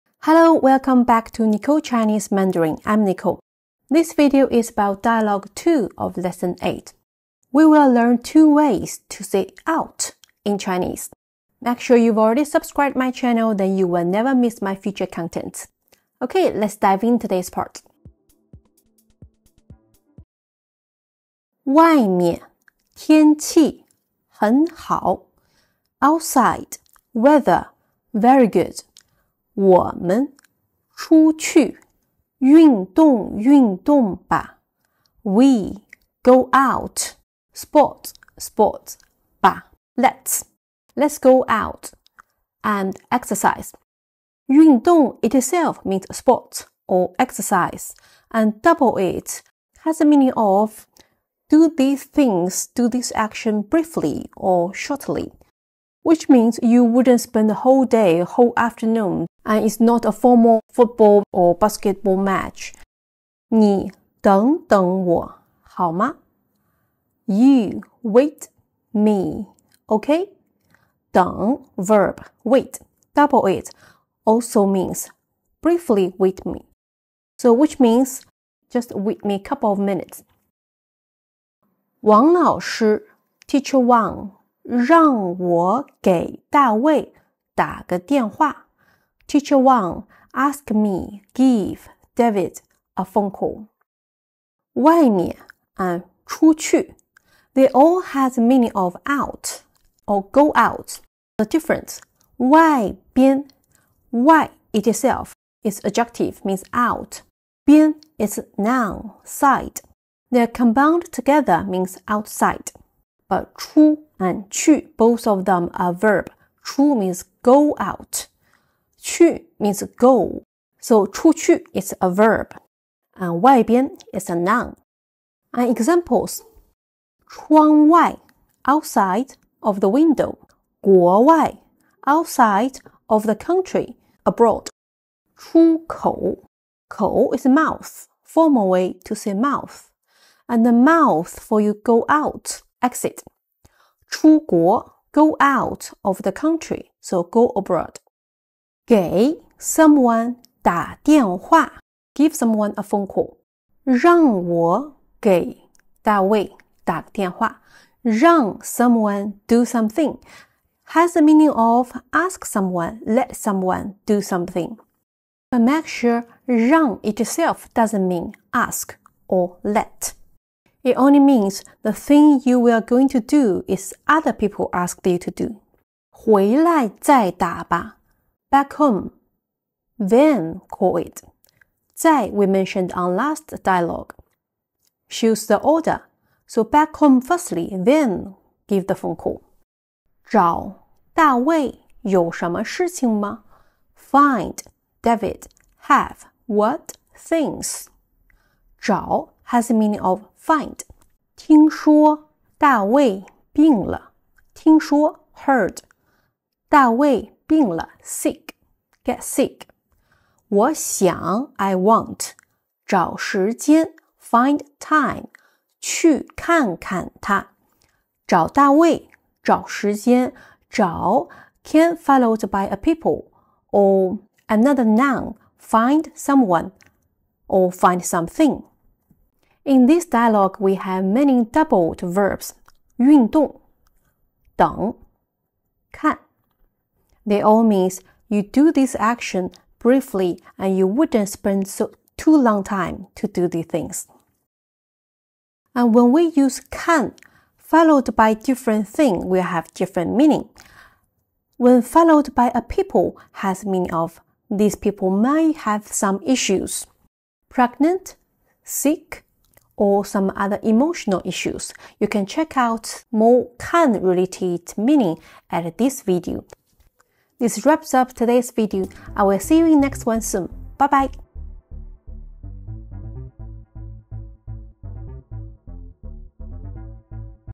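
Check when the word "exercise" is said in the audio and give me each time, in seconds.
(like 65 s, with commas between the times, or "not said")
43 s, 47 s.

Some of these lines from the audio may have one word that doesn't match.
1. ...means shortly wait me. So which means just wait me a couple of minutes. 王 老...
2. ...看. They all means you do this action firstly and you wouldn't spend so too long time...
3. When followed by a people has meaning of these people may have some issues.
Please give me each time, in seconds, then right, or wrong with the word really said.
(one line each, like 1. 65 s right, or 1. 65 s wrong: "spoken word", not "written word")
1. 74 s wrong: "briefly", not "shortly"
2. 235 s wrong: "briefly", not "firstly"
3. 251 s right.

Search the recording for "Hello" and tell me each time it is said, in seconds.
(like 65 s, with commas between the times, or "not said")
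0 s.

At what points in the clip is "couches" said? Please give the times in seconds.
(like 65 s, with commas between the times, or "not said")
not said.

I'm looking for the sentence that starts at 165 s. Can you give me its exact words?
But make sure 让 itself doesn't mean ask or let.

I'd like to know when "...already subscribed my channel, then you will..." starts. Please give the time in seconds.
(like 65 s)
12 s.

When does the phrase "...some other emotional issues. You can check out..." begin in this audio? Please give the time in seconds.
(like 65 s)
260 s.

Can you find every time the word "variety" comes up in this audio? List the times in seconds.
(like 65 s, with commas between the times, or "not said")
not said.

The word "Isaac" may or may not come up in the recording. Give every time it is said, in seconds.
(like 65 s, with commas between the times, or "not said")
not said.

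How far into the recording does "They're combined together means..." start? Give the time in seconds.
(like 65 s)
110 s.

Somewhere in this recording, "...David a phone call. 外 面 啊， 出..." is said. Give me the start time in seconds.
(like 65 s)
92 s.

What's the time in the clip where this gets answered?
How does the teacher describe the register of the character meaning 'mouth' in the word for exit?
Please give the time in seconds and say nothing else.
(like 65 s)
138 s.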